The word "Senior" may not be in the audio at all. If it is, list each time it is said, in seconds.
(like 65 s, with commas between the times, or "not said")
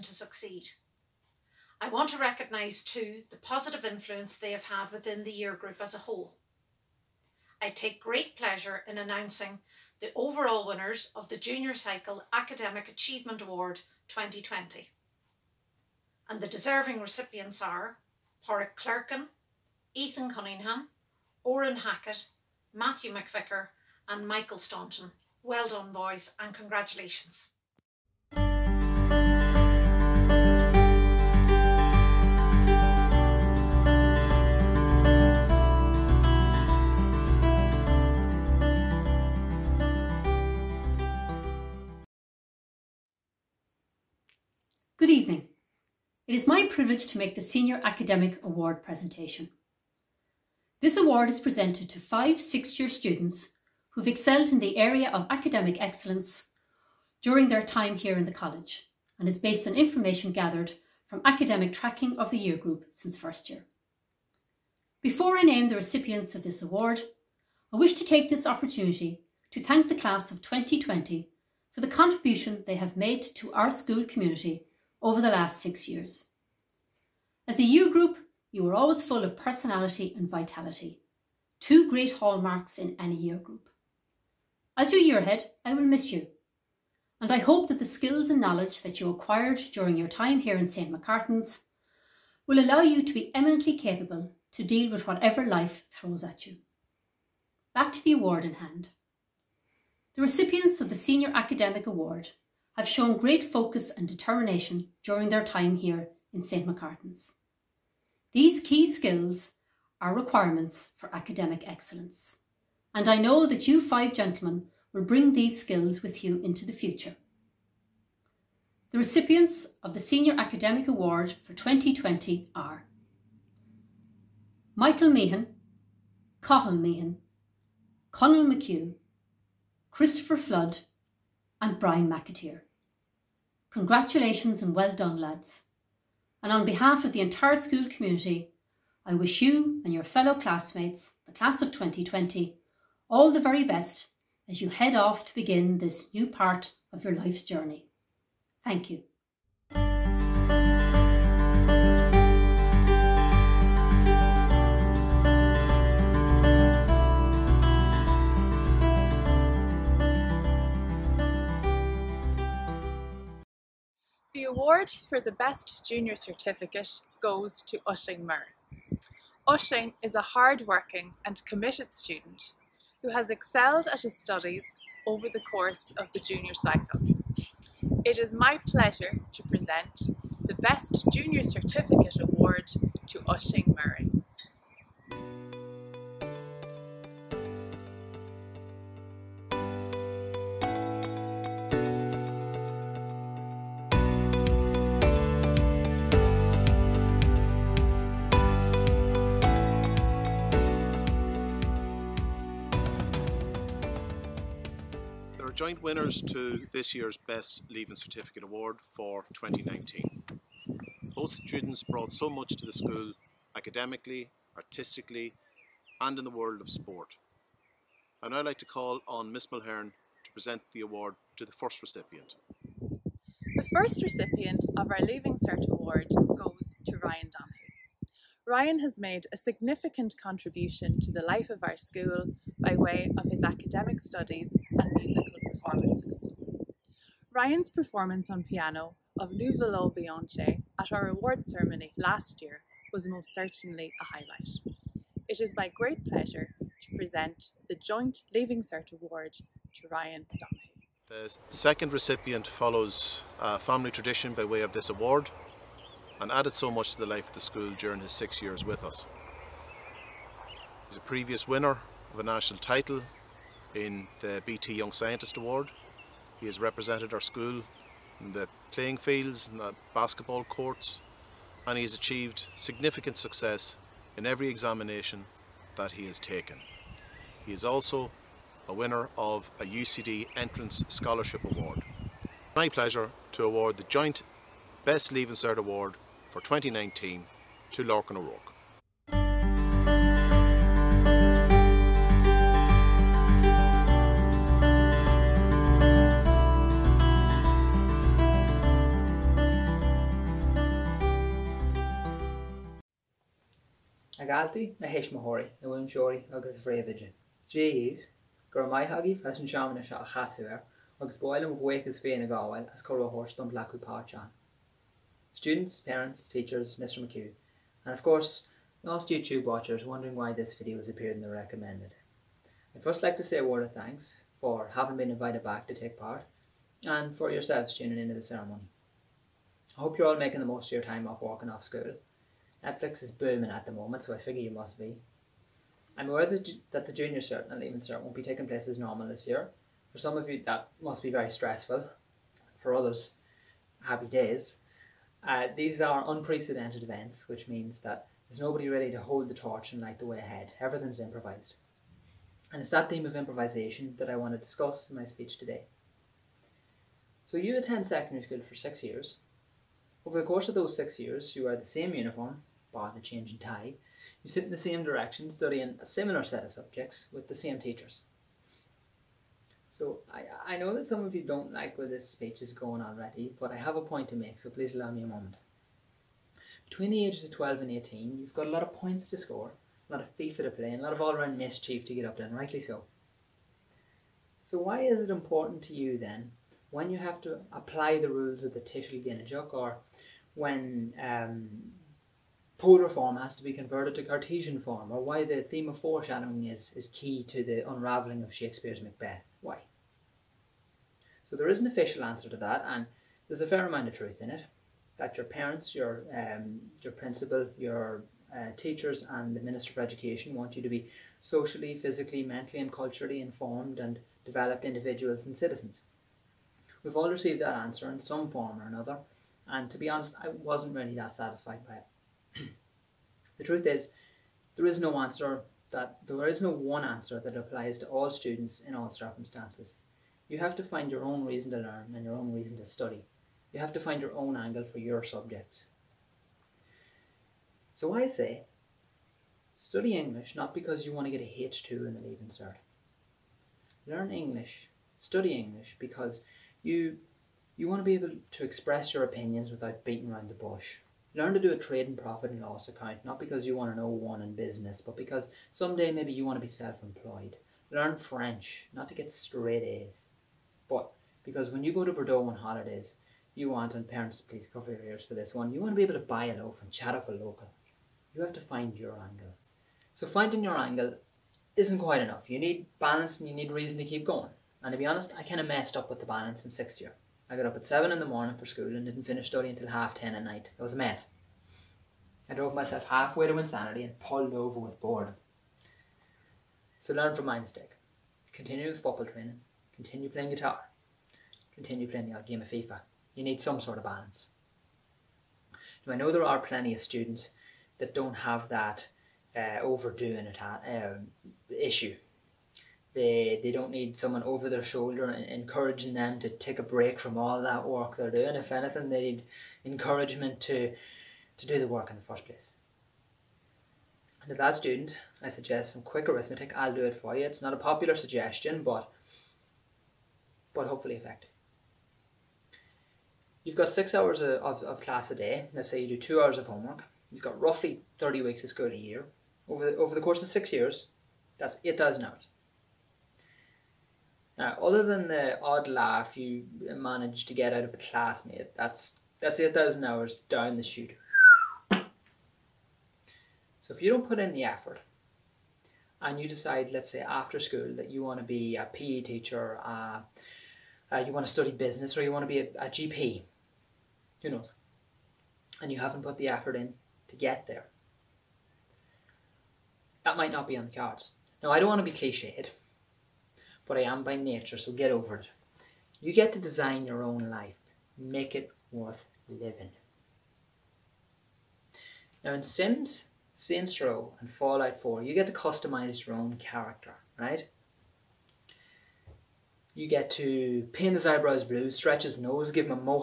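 47 s, 100 s, 119 s.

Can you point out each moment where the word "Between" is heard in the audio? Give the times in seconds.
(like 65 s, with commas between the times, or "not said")
376 s.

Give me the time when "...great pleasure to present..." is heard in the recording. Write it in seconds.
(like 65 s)
245 s.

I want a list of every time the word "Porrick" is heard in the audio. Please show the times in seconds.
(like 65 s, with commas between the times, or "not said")
18 s.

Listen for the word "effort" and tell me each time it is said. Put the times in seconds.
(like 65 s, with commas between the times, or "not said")
544 s, 556 s.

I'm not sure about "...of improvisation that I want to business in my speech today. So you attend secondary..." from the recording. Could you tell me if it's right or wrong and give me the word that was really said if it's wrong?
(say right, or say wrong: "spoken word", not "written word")
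wrong: "discuss", not "business".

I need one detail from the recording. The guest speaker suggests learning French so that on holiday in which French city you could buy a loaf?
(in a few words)
Bordeaux.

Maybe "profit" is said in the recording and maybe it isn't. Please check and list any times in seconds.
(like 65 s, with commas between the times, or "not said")
451 s.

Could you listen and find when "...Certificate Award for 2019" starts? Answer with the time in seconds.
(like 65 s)
207 s.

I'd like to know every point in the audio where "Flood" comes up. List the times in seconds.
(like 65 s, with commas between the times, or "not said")
130 s.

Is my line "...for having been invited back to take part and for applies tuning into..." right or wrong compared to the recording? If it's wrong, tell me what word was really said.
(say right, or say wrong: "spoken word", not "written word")
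wrong: "yourselves", not "applies".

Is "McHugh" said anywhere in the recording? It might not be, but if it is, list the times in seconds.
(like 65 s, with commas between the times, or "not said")
128 s, 317 s.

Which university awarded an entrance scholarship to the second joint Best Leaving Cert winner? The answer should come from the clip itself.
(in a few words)
UCD.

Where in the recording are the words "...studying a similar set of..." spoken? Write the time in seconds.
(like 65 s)
365 s.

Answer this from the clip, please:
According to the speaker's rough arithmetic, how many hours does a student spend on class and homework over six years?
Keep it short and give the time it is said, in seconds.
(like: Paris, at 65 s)
8,000, at 531 s.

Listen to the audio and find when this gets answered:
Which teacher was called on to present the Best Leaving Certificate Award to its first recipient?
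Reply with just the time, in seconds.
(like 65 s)
219 s.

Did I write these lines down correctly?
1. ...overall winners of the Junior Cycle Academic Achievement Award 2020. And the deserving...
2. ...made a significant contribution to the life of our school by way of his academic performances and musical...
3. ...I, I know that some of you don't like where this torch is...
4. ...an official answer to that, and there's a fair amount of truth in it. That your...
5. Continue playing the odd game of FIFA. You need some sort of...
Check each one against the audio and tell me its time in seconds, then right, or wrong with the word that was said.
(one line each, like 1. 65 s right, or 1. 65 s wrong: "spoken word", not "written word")
1. 10 s right
2. 228 s wrong: "studies", not "performances"
3. 370 s wrong: "speech", not "torch"
4. 401 s right
5. 491 s right.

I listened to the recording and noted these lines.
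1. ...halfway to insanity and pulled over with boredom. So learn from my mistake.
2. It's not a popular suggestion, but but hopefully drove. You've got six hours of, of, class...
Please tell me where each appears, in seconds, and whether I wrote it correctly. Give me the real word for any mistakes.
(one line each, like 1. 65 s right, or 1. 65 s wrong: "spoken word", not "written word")
1. 482 s right
2. 517 s wrong: "effective", not "drove".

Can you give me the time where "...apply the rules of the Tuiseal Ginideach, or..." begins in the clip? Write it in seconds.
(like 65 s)
387 s.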